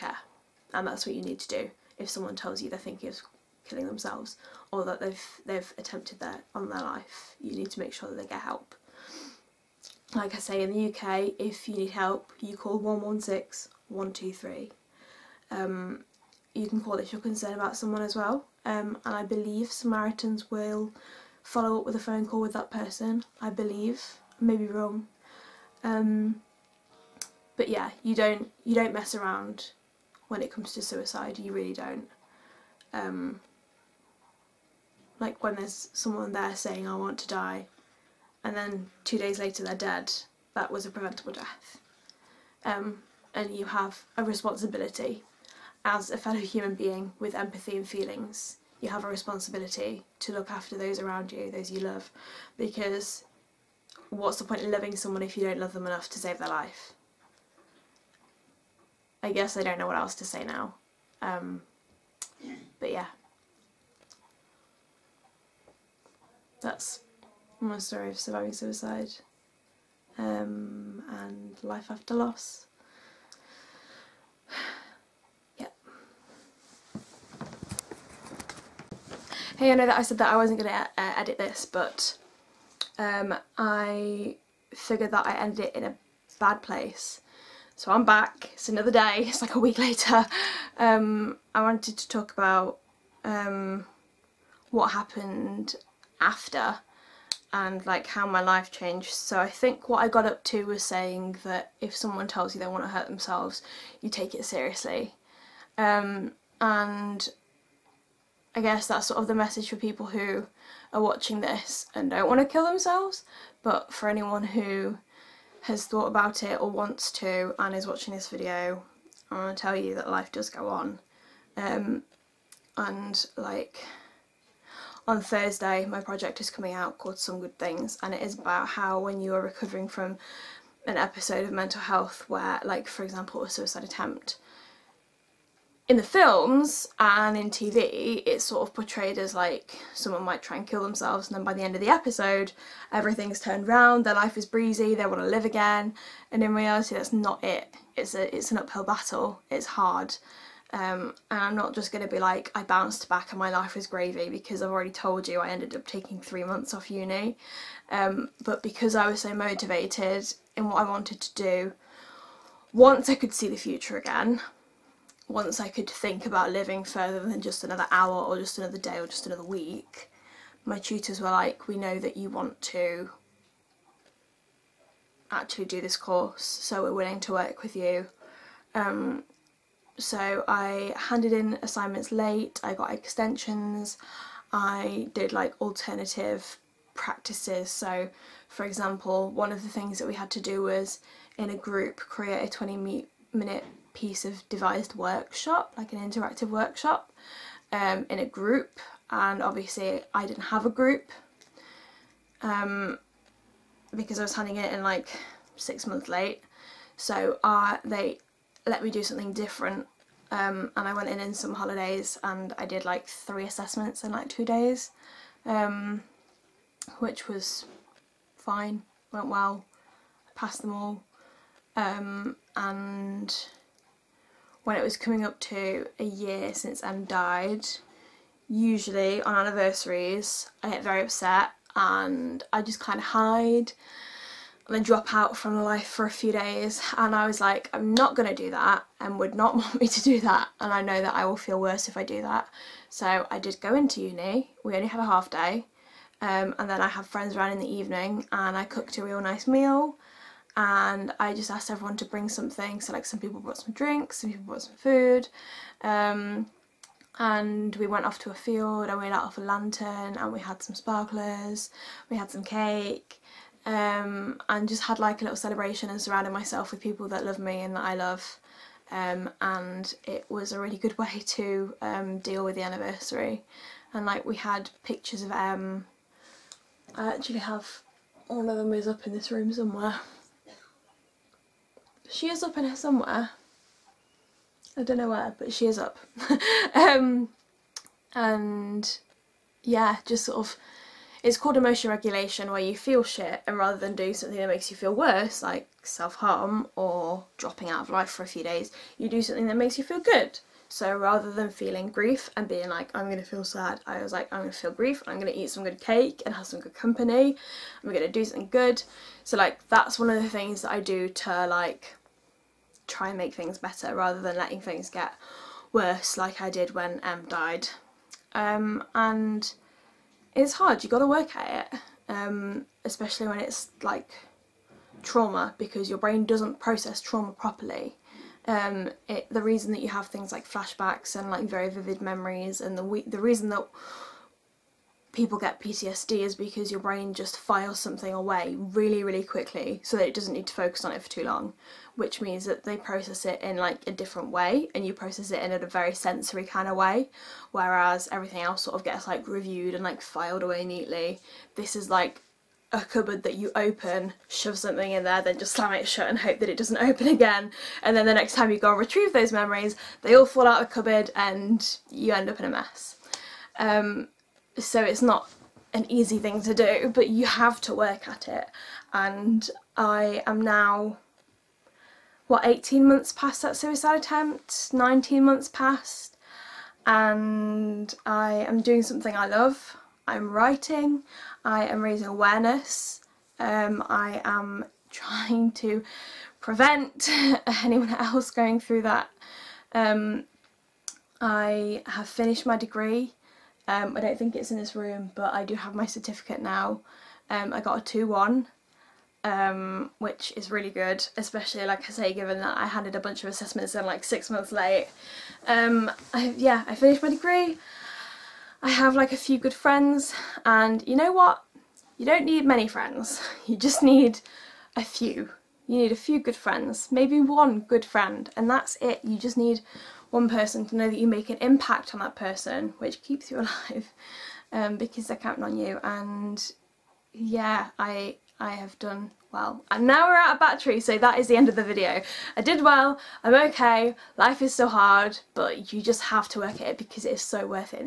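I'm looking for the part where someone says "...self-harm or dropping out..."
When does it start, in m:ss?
4:55.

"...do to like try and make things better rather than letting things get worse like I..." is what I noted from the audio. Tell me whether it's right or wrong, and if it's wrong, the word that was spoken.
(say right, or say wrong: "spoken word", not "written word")
right.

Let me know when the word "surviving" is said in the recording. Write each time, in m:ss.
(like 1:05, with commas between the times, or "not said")
1:08.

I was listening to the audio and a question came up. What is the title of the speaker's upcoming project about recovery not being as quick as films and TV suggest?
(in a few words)
Some Good Things.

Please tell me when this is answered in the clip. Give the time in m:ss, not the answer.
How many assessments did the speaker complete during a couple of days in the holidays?
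3:33.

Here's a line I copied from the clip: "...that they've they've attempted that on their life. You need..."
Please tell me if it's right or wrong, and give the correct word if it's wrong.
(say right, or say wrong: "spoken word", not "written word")
right.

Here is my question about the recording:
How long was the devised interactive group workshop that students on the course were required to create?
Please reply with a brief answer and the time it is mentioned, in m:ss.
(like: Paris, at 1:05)
20 minutes, at 3:12.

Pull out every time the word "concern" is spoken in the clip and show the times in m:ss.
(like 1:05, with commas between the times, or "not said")
0:17.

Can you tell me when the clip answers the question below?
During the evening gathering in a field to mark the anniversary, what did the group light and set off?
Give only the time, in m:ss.
4:19.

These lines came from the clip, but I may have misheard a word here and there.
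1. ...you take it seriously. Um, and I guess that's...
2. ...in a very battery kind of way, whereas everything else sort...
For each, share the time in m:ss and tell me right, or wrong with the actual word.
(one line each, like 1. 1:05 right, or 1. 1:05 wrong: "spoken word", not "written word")
1. 1:44 right
2. 5:45 wrong: "sensory", not "battery".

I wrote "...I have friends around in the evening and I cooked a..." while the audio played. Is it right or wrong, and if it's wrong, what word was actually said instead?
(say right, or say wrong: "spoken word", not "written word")
right.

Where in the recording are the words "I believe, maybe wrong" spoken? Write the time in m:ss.
0:23.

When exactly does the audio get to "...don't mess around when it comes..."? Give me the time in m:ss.
0:28.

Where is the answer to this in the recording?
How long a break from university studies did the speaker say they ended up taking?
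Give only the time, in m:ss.
2:36.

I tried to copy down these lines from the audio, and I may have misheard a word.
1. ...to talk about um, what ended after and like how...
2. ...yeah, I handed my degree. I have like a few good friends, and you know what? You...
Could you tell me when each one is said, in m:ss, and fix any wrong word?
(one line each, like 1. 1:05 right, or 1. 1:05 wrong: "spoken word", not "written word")
1. 1:31 wrong: "happened", not "ended"
2. 6:46 wrong: "finished", not "handed".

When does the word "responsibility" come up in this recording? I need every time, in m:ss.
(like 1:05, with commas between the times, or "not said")
0:44, 0:49.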